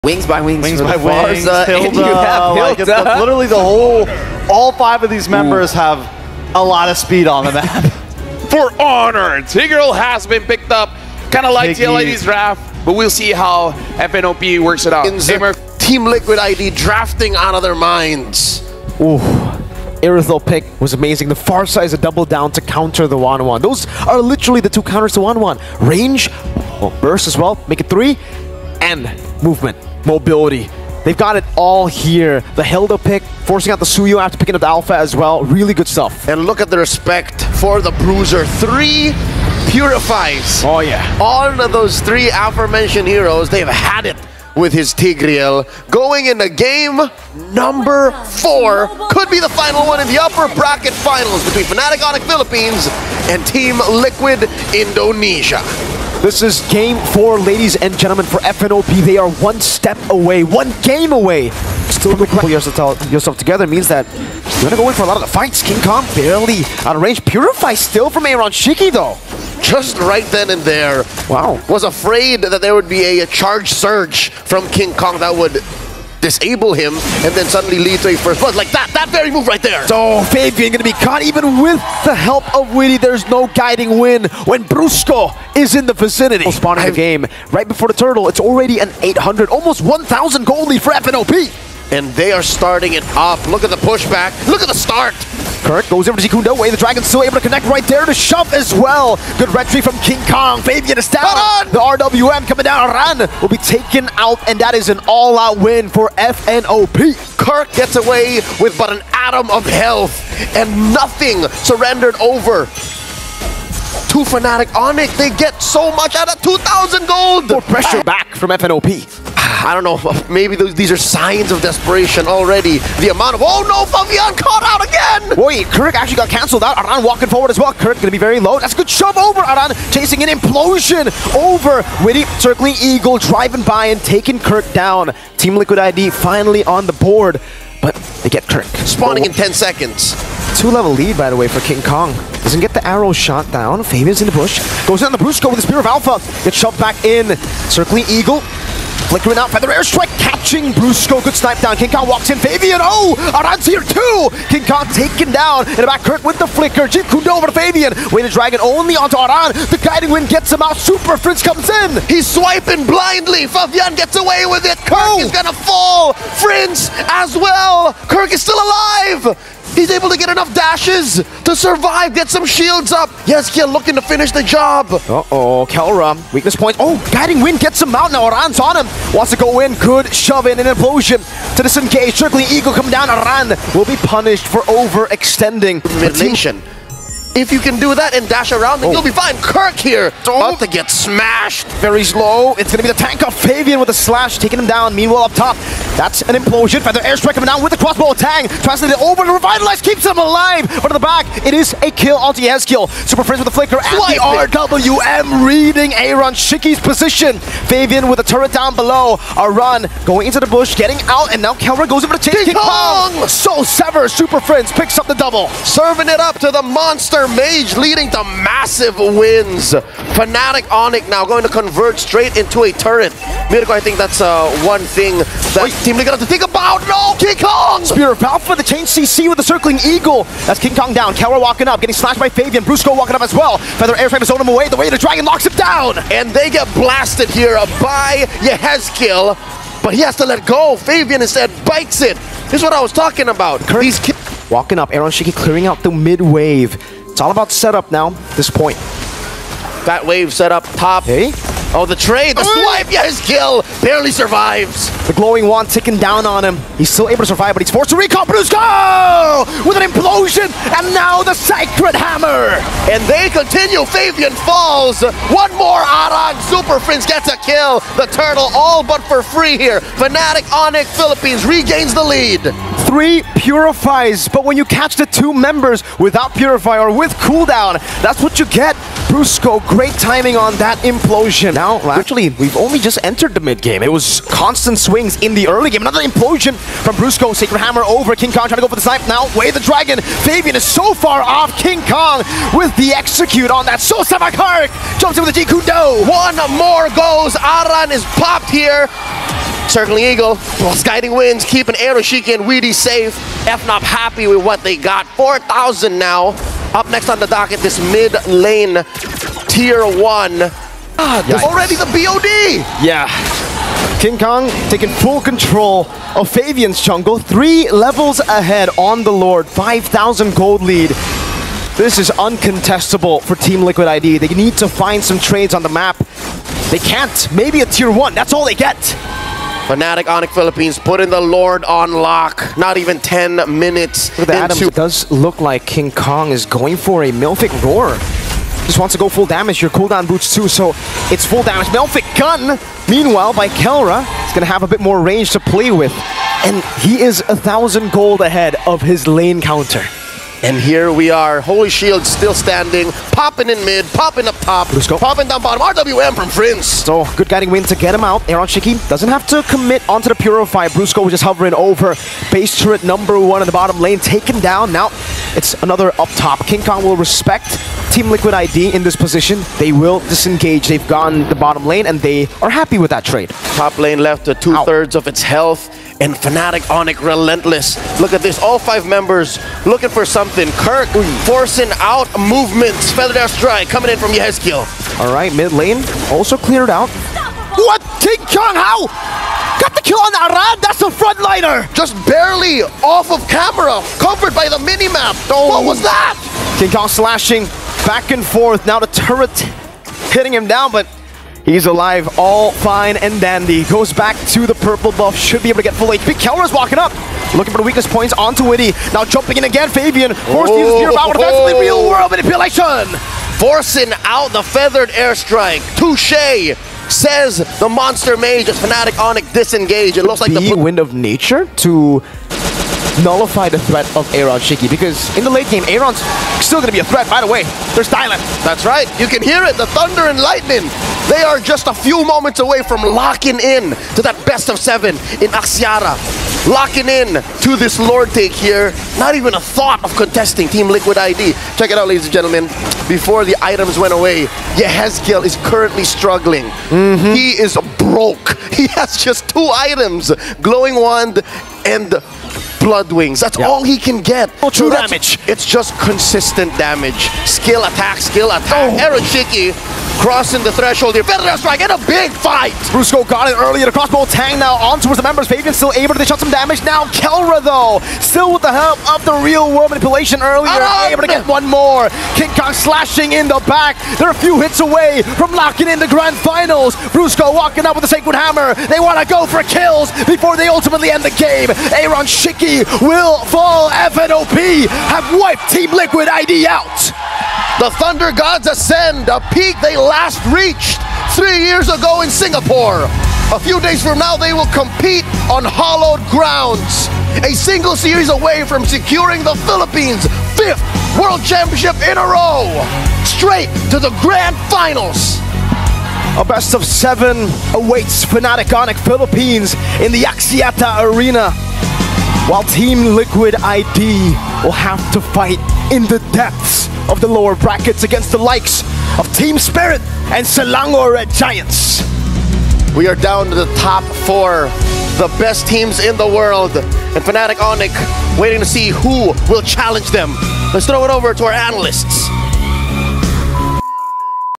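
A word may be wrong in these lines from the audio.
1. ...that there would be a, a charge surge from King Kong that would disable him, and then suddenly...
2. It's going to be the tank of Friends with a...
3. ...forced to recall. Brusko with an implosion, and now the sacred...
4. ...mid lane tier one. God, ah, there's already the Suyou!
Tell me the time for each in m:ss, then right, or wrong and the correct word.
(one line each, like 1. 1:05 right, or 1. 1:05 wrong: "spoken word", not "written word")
1. 1:12 right
2. 3:12 wrong: "Fabian", not "Friends"
3. 4:17 right
4. 5:07 wrong: "BOD", not "Suyou".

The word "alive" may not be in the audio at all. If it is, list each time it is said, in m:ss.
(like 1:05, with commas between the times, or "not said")
2:48, 3:20, 6:41.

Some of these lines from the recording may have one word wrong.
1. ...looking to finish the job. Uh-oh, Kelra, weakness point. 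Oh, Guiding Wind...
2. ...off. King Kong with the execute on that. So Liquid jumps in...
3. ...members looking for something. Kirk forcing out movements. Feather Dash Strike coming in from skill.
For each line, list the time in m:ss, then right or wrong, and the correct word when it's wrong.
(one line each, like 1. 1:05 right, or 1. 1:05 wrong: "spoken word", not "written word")
1. 2:53 right
2. 4:51 wrong: "Samakaric", not "Liquid"
3. 6:18 right.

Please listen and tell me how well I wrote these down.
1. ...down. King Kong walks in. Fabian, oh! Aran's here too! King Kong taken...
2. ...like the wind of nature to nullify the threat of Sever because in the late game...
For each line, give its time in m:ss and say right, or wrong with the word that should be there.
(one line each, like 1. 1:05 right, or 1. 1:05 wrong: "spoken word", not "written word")
1. 2:31 right
2. 7:00 wrong: "Aeronshiki", not "Sever".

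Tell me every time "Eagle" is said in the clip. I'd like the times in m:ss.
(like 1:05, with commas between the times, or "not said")
2:12, 2:28, 3:02, 3:49, 5:00.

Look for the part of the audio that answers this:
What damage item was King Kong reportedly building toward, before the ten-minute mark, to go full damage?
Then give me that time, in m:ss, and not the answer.
5:37.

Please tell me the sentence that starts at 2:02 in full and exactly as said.
The amount of, oh no, Fabian caught out again!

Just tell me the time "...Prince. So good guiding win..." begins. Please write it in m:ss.
5:56.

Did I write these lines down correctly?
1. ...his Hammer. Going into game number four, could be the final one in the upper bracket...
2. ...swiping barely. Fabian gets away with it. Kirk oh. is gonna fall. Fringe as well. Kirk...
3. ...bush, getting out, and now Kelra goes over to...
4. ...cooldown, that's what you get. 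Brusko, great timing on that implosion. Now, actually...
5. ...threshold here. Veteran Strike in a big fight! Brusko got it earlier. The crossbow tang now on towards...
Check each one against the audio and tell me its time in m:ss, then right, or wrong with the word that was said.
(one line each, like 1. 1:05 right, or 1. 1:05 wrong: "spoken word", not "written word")
1. 0:44 wrong: "Tigreal", not "Hammer"
2. 2:42 wrong: "blindly", not "barely"
3. 3:30 right
4. 4:37 right
5. 7:40 right.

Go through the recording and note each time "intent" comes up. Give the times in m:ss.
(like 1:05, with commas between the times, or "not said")
not said.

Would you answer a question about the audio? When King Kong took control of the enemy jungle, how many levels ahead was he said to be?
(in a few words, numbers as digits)
3.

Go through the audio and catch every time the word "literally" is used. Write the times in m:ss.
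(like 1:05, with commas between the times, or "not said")
0:02, 0:24.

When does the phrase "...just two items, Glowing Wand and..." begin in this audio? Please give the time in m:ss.
7:29.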